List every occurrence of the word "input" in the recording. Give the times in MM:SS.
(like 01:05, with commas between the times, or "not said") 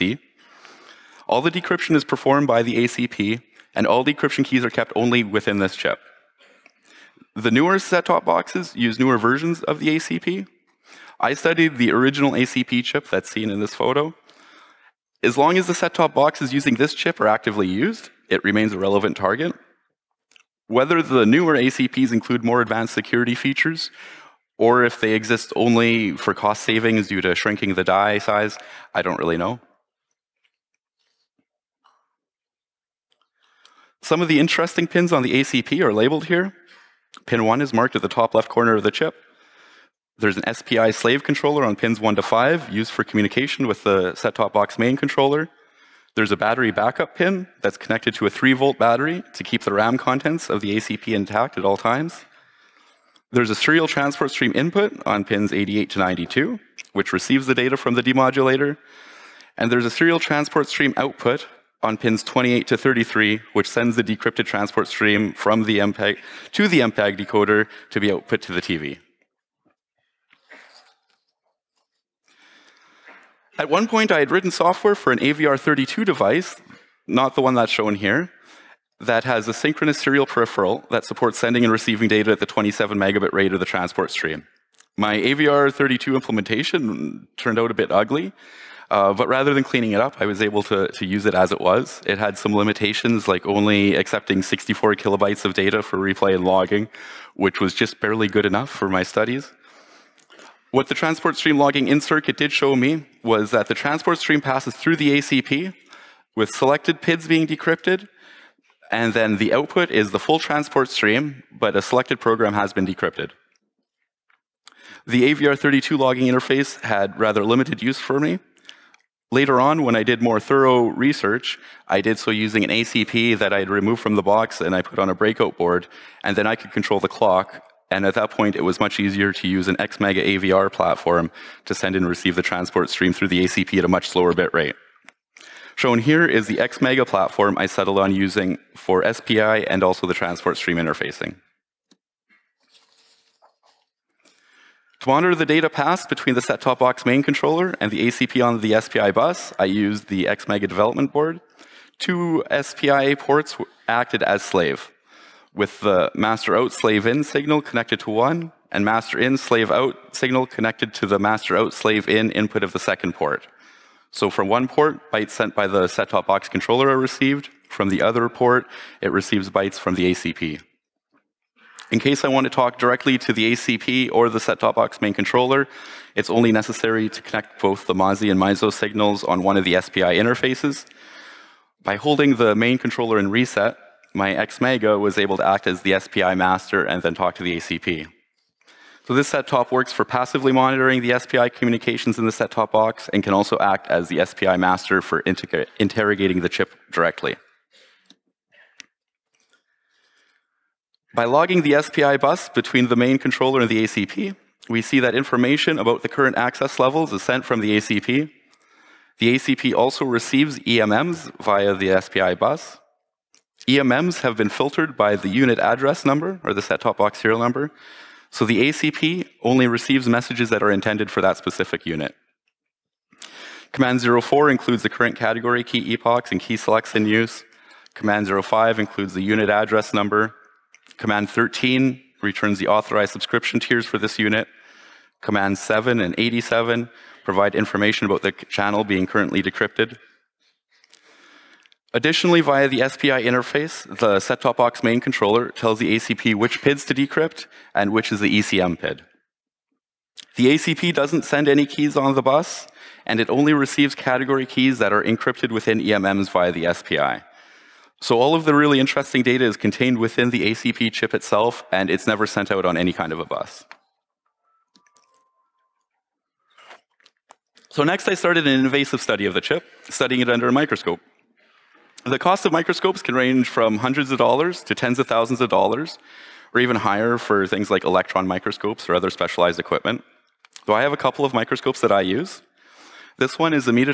00:54, 02:42.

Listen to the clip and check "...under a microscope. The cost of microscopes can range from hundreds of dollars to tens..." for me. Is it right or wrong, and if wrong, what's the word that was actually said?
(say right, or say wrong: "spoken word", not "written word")
right.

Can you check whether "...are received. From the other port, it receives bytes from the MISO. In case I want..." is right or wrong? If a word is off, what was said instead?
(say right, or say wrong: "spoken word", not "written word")
wrong: "ACP", not "MISO".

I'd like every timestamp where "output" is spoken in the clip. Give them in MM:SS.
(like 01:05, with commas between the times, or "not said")
01:00, 01:08, 01:49.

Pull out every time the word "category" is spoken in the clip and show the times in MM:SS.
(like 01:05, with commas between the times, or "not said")
03:45, 04:13.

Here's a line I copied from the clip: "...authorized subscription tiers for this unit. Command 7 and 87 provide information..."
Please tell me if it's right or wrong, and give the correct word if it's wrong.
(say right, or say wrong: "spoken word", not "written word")
right.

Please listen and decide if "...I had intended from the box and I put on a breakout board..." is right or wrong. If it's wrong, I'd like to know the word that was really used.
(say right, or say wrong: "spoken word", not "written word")
wrong: "removed", not "intended".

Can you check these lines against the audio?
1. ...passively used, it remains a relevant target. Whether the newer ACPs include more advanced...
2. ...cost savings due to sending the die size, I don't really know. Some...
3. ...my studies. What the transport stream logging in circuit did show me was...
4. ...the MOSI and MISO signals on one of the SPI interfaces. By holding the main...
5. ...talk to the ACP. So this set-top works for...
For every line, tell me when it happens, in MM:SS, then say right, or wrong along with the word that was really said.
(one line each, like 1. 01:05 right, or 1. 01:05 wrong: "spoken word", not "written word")
1. 00:17 wrong: "actively", not "passively"
2. 00:26 wrong: "shrinking", not "sending"
3. 01:38 right
4. 02:57 right
5. 03:07 right.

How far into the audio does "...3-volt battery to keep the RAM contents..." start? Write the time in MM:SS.
00:48.